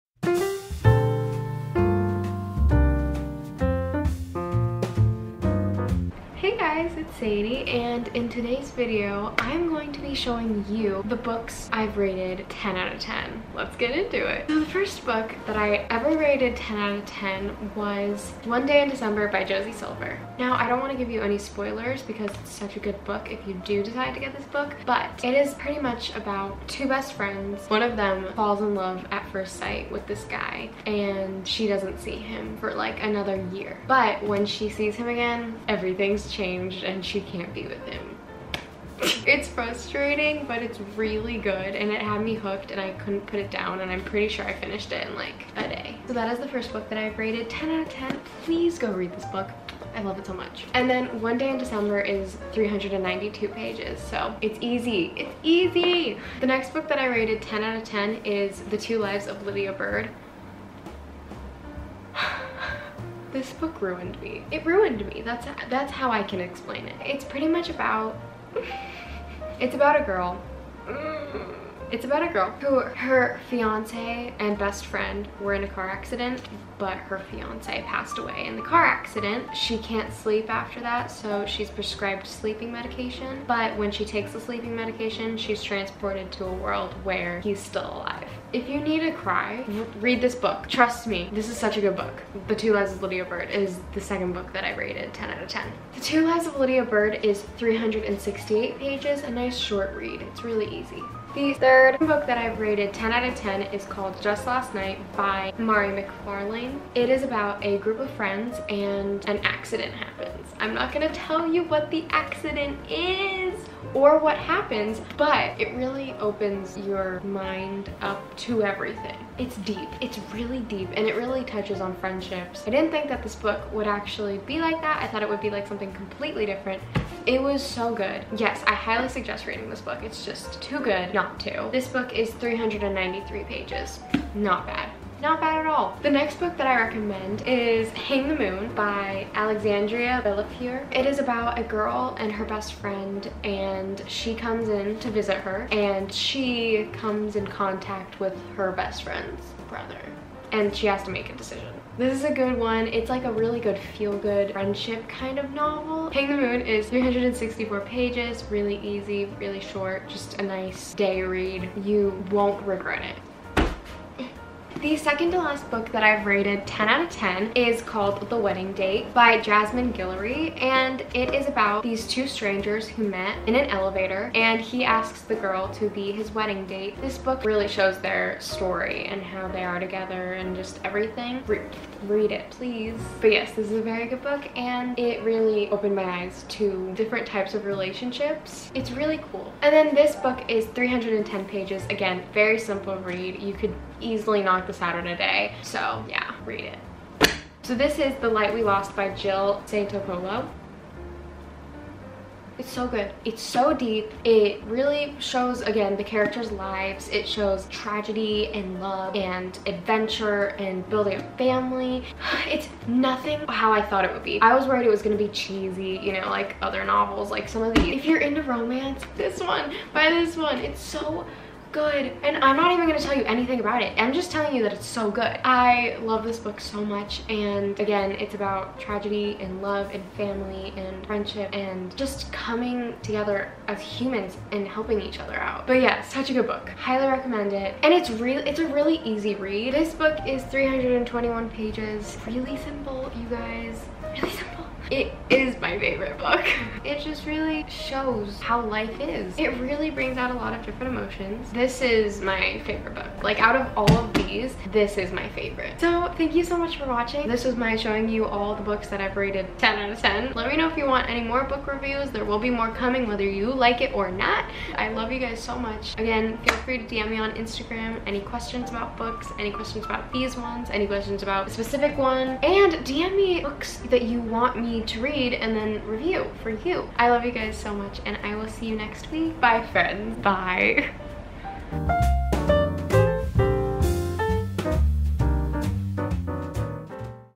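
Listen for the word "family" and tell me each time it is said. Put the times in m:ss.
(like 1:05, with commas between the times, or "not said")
3:31, 3:50.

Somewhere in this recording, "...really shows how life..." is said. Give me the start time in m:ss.
4:07.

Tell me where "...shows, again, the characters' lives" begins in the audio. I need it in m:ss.
3:25.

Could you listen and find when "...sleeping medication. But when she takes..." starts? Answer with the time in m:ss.
1:22.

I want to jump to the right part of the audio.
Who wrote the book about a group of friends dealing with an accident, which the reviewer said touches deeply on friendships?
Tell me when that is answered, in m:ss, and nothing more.
1:45.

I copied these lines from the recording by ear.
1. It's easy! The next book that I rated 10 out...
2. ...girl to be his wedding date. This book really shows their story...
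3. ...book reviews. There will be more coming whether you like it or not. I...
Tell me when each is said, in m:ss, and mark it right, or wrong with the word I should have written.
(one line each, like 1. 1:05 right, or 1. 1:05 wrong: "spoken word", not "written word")
1. 0:55 right
2. 2:55 right
3. 4:21 right.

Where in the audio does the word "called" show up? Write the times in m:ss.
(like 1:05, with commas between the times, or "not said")
1:43, 2:47.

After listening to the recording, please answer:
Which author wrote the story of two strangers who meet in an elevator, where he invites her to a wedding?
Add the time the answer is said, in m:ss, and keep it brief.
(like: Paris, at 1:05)
Jasmine Guillory, at 2:49.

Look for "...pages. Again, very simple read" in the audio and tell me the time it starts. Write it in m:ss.
3:11.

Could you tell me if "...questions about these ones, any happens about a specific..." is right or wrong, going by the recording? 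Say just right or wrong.
wrong.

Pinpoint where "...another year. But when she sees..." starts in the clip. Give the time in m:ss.
0:33.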